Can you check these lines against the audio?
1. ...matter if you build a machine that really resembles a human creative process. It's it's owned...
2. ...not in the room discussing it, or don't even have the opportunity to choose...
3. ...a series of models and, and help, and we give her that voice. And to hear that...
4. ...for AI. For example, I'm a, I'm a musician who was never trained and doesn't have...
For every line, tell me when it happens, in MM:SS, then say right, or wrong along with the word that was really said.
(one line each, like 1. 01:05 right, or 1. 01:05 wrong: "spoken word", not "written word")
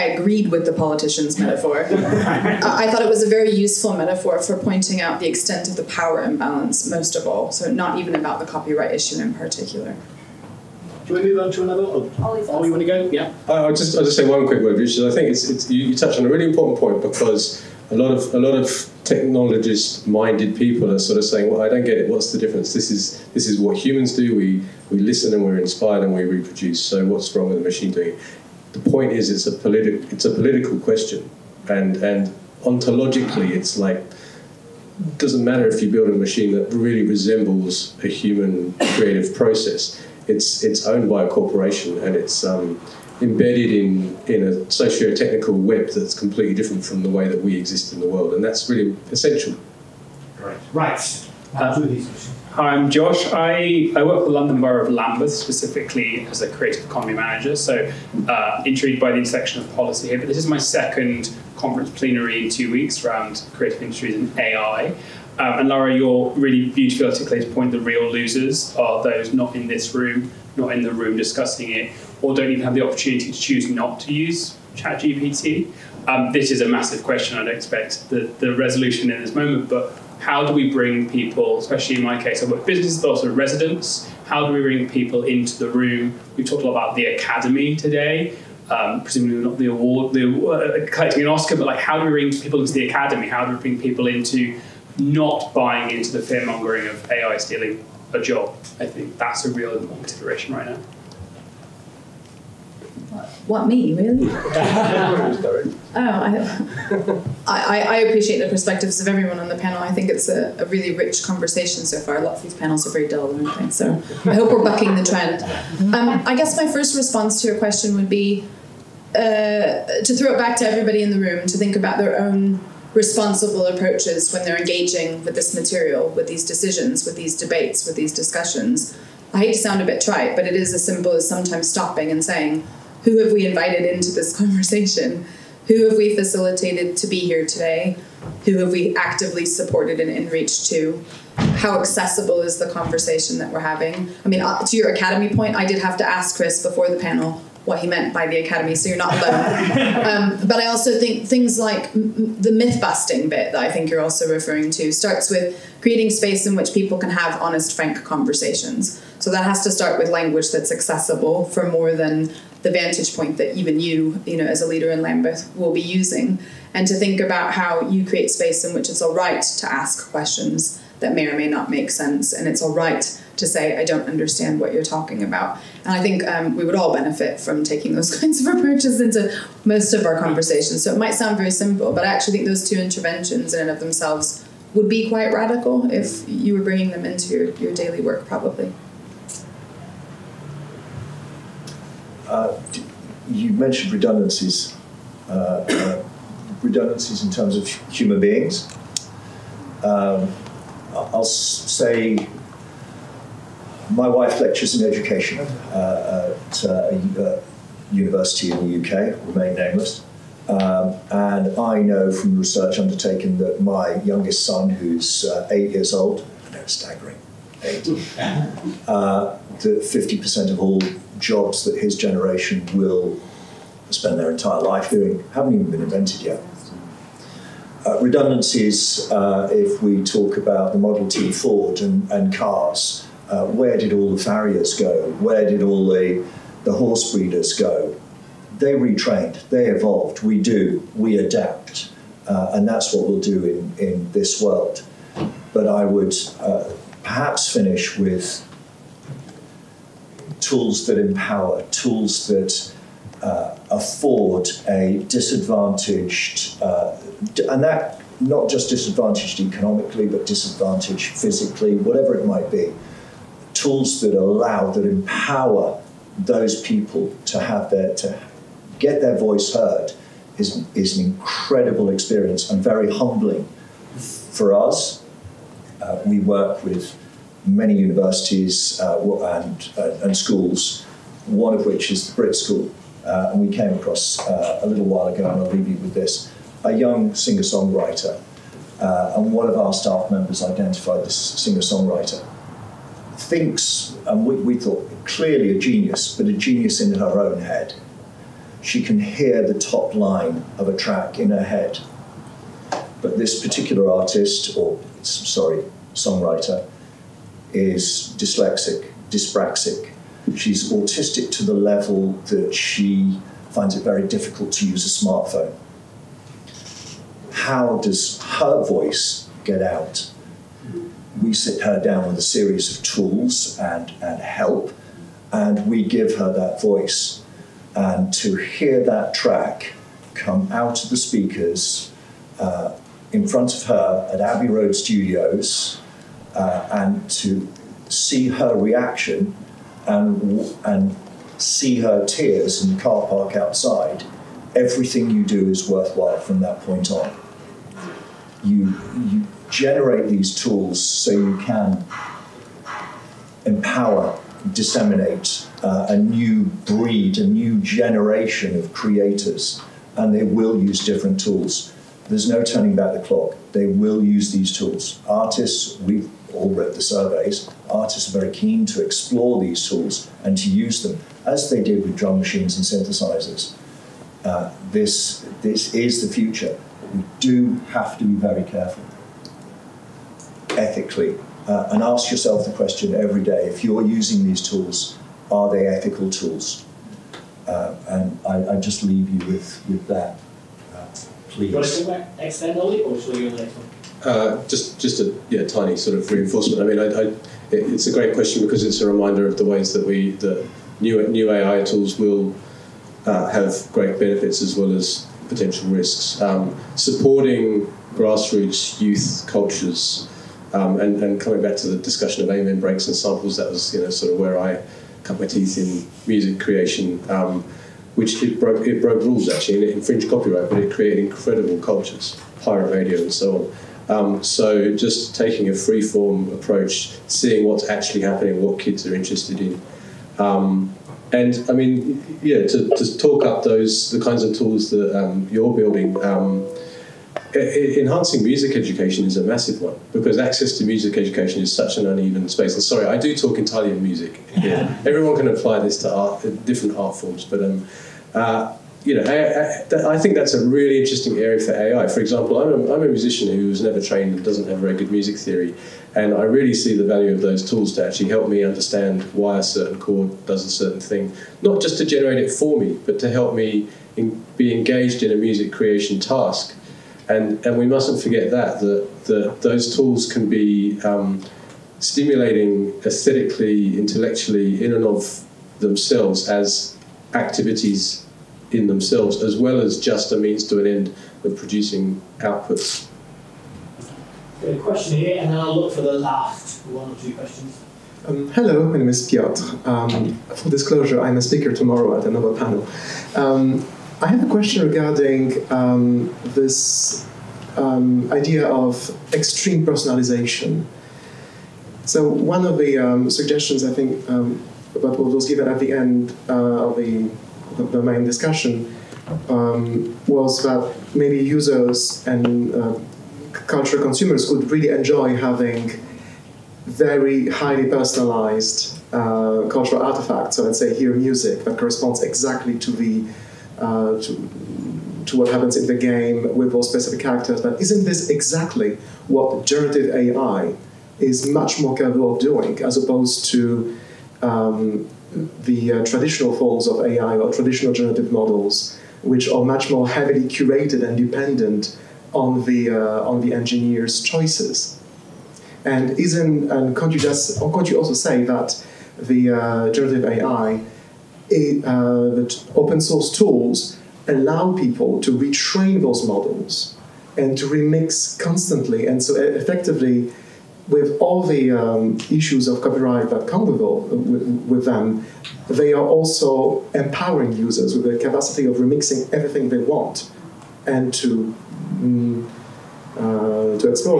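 1. 00:35 right
2. 01:10 right
3. 05:22 wrong: "tools", not "models"
4. 07:31 right.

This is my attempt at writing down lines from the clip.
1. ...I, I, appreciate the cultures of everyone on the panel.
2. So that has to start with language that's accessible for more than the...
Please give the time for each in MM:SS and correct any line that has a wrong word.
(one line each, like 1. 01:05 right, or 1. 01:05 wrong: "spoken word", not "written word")
1. 01:47 wrong: "perspectives", not "cultures"
2. 02:39 right.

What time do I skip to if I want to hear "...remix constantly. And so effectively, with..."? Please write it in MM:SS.
09:17.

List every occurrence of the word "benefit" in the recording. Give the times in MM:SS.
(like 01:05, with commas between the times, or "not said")
02:56, 06:43.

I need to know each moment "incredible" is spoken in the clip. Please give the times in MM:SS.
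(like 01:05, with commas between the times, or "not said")
04:31, 07:01.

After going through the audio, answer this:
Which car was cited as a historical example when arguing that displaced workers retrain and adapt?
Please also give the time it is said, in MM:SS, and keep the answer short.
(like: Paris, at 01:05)
Model T Ford, at 03:50.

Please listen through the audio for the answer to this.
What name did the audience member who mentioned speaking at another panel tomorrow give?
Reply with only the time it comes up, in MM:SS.
08:09.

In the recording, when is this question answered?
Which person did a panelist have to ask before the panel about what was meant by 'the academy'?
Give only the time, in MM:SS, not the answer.
02:26.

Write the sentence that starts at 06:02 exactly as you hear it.
There's no turning back the clock.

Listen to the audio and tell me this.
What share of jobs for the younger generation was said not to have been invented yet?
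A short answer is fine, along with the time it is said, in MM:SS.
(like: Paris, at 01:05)
50%, at 03:39.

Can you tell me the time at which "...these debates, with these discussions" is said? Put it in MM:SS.
02:07.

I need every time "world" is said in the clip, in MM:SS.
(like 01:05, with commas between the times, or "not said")
00:48, 04:04.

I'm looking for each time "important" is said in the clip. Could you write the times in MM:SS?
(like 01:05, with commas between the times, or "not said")
00:16, 01:39.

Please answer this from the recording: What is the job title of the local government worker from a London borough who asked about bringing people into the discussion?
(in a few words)
creative economy manager.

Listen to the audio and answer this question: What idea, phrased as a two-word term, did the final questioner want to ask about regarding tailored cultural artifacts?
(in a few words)
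extreme personalization.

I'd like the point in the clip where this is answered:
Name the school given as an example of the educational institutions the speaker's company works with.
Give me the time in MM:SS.
04:42.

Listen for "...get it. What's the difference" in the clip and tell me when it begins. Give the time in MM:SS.
00:21.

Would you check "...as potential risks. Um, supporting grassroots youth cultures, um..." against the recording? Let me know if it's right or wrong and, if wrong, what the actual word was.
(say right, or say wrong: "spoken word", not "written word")
right.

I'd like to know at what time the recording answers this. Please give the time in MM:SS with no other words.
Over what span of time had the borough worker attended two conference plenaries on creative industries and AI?
01:02.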